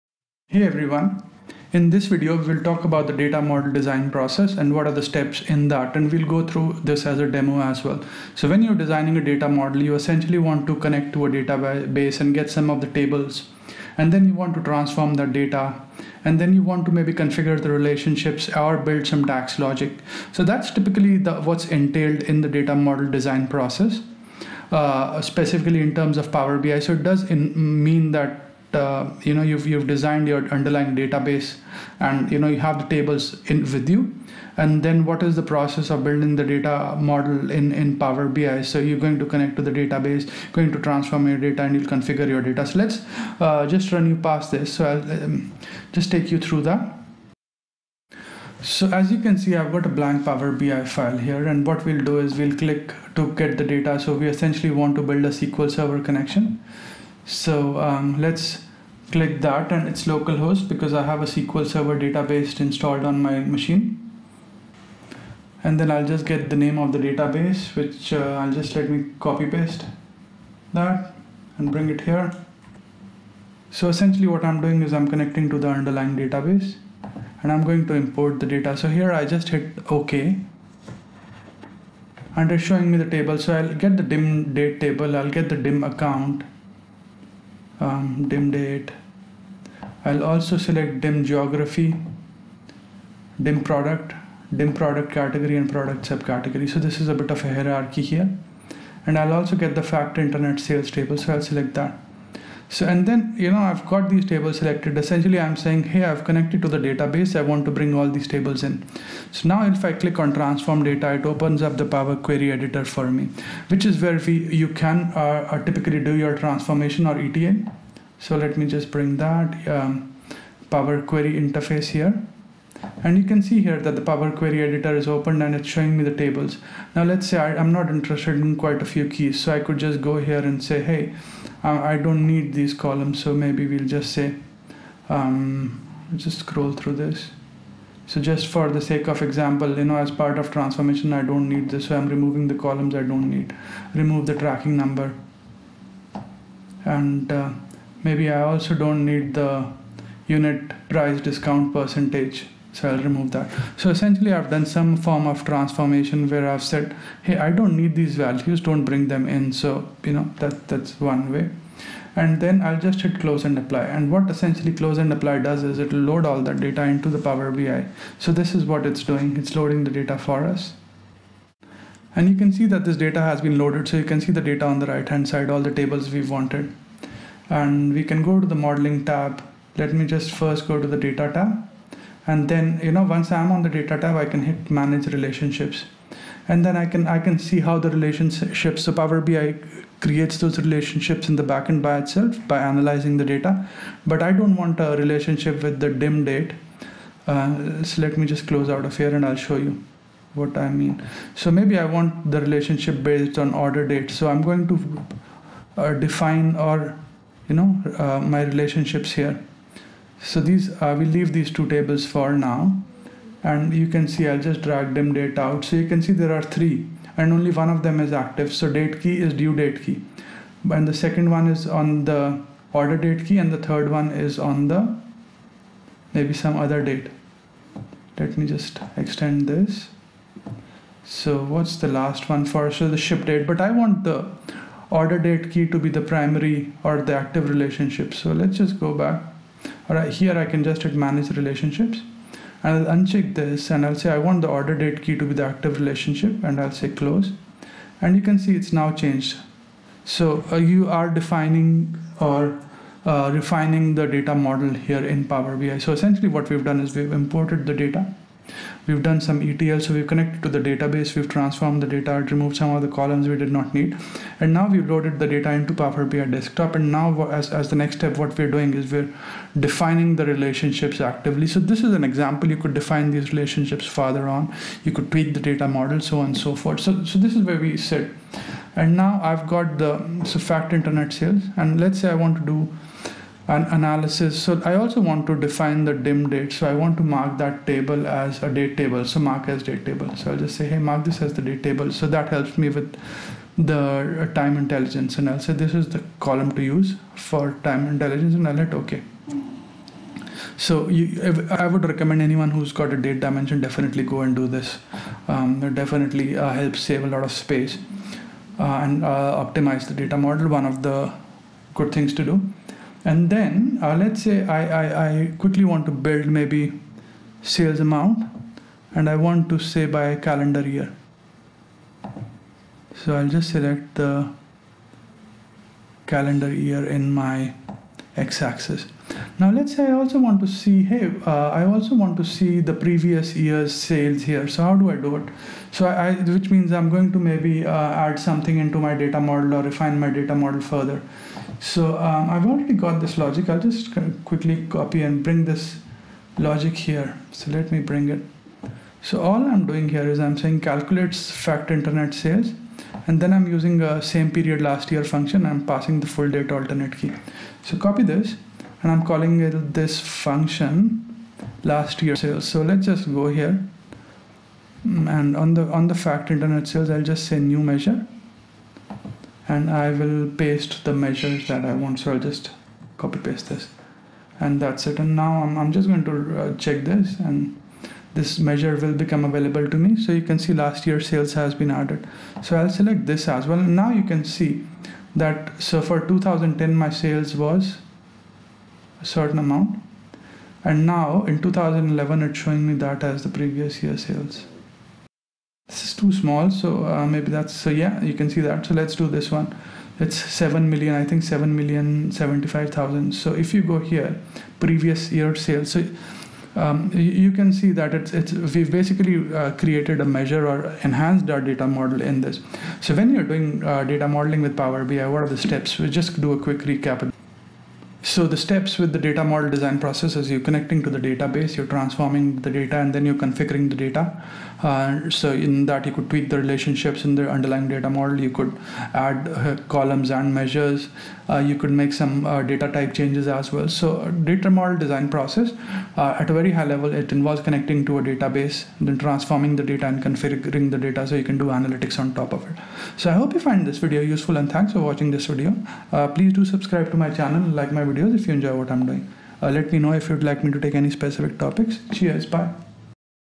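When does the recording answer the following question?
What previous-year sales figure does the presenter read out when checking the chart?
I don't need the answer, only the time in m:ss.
6:41.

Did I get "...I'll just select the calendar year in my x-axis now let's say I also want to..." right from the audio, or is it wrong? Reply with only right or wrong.
right.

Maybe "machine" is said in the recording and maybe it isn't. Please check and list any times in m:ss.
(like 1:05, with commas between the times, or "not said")
1:03.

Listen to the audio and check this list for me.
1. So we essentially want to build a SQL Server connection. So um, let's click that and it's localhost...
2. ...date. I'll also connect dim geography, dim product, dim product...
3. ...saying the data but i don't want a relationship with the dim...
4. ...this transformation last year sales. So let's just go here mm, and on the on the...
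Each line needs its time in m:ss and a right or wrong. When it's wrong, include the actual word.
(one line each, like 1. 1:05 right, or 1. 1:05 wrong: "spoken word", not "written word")
1. 0:53 right
2. 1:28 wrong: "select", not "connect"
3. 3:12 wrong: "analyzing", not "saying"
4. 5:59 wrong: "function", not "transformation".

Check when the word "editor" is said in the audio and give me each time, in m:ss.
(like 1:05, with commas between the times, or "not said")
1:52, 2:04.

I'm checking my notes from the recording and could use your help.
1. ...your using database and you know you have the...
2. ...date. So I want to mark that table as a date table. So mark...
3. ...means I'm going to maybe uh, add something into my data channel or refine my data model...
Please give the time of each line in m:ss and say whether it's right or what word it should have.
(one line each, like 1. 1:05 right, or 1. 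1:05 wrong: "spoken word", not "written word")
1. 0:30 wrong: "underlying", not "using"
2. 4:46 right
3. 5:36 wrong: "model", not "channel".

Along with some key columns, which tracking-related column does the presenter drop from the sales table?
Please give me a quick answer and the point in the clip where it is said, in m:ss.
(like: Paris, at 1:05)
tracking number, at 2:24.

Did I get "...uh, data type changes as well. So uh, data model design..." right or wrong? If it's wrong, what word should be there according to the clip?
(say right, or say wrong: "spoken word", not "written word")
right.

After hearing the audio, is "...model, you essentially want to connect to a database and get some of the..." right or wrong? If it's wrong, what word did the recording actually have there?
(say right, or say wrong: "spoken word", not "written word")
right.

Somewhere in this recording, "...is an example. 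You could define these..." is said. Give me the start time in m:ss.
4:31.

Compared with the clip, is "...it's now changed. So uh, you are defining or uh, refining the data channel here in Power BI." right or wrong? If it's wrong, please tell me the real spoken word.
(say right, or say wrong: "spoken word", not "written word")
wrong: "model", not "channel".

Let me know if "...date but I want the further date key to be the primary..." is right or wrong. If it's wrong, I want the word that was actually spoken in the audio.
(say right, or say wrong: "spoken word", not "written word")
wrong: "order", not "further".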